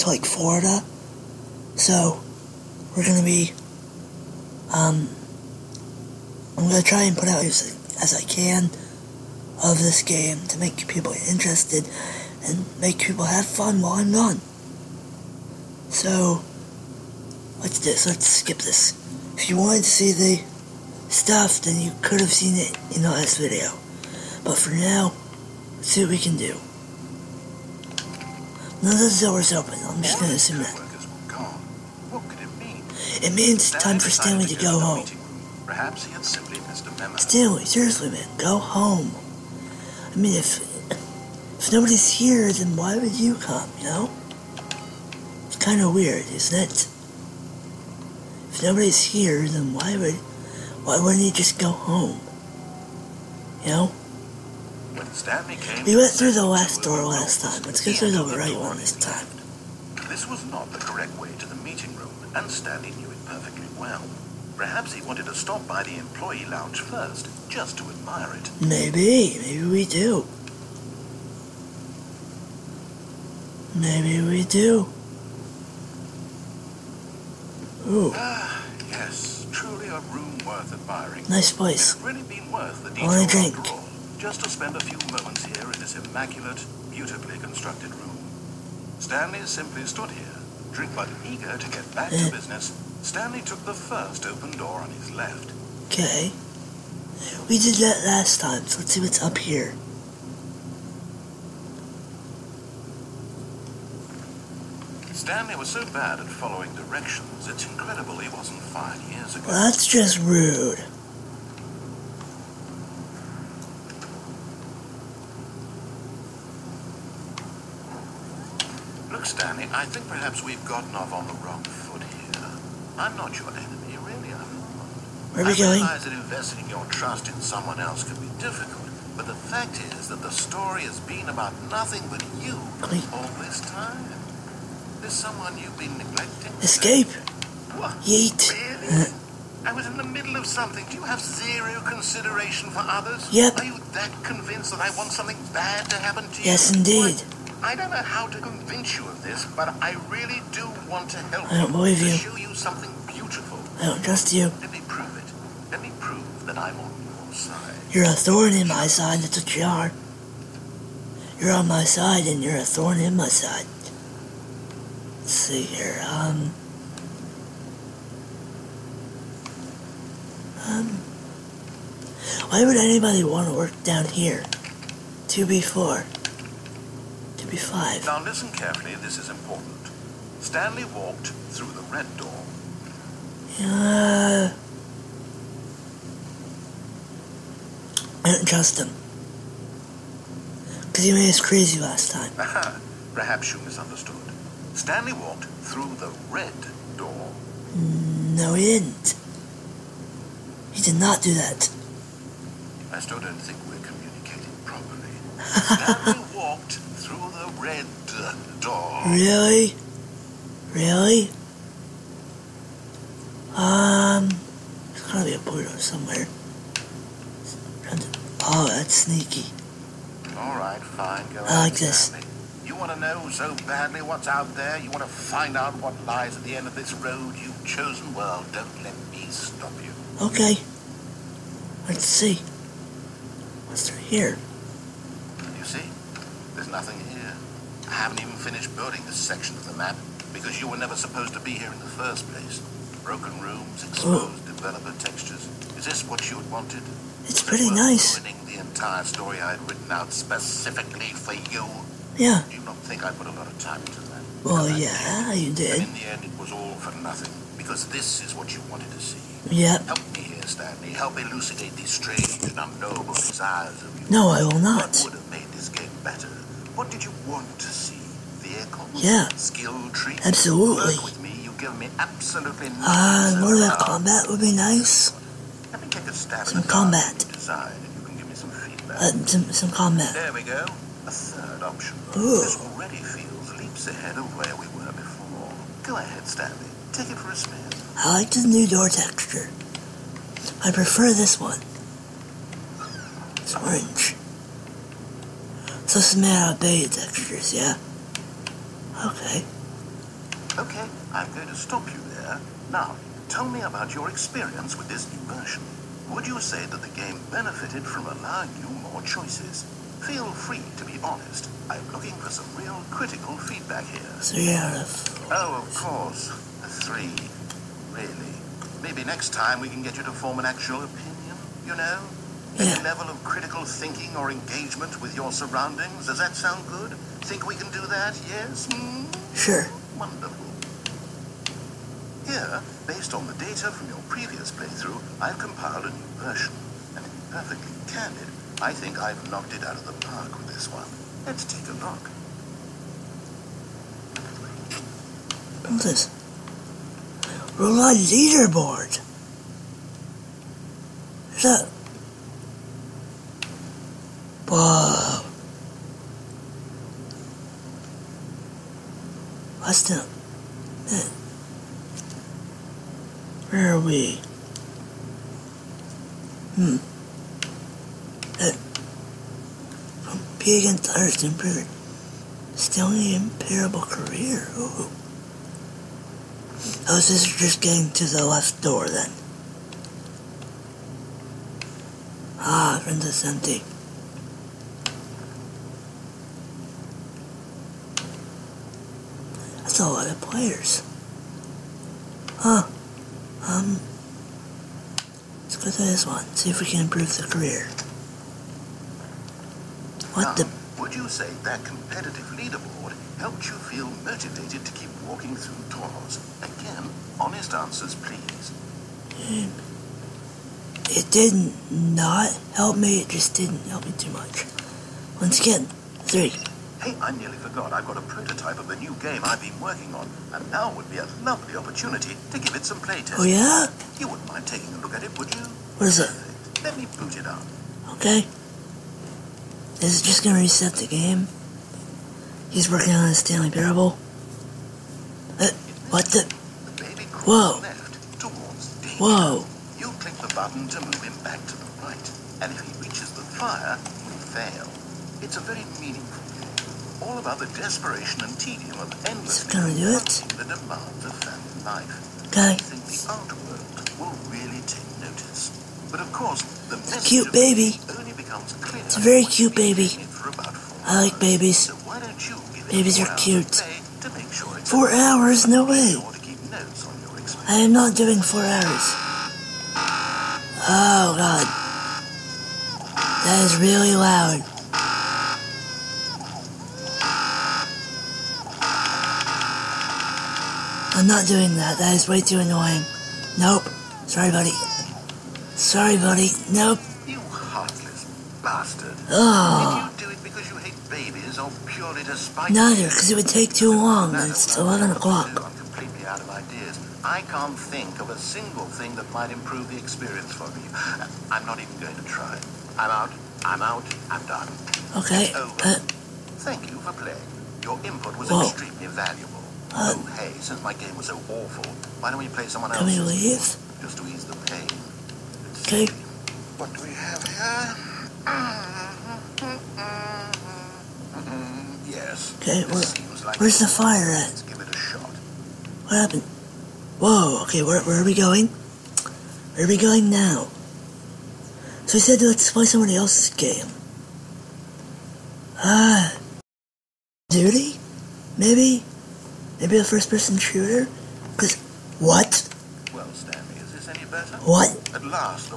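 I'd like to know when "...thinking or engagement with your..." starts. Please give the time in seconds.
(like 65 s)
323 s.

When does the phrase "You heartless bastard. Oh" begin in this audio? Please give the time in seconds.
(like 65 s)
487 s.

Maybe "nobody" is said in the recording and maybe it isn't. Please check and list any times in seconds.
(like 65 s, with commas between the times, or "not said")
41 s, 48 s.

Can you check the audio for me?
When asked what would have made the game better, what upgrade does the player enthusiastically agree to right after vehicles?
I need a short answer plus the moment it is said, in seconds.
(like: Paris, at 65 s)
Skill tree, at 269 s.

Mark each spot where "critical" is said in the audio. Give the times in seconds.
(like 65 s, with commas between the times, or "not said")
312 s, 323 s.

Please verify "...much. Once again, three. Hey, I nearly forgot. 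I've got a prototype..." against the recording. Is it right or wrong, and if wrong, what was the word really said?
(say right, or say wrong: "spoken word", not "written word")
right.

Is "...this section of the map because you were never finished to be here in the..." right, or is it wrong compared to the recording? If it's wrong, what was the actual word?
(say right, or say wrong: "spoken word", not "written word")
wrong: "supposed", not "finished".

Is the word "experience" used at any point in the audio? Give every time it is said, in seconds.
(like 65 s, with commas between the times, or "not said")
304 s, 499 s.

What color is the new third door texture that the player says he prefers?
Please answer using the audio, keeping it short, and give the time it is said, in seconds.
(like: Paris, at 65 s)
Orange, at 293 s.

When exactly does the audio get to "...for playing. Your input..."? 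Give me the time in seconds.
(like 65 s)
506 s.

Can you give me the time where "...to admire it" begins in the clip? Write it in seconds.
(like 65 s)
67 s.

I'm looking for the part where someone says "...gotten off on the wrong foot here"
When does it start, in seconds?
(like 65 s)
120 s.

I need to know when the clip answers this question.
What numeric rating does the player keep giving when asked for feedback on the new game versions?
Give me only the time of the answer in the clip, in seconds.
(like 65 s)
314 s.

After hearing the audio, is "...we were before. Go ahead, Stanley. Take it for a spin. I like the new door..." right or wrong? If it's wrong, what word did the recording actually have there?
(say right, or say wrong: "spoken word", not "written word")
right.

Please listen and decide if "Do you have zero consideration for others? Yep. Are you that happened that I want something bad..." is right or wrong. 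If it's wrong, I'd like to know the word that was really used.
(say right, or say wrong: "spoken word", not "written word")
wrong: "convinced", not "happened".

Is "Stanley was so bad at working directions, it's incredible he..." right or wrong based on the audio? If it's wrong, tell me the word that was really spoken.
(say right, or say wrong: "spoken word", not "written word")
wrong: "following", not "working".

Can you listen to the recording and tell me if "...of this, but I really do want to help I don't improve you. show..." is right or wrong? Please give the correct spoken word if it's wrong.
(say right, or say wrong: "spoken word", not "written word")
wrong: "believe", not "improve".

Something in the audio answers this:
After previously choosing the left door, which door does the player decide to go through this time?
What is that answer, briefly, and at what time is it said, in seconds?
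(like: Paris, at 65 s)
The right one, at 58 s.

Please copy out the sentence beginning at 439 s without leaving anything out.
You click the button to move him back to the right, and if he reaches the fire, you fail.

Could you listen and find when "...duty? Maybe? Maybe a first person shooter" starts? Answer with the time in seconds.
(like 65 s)
537 s.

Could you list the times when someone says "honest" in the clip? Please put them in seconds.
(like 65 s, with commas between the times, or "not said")
311 s, 407 s.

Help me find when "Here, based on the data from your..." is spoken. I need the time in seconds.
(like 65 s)
332 s.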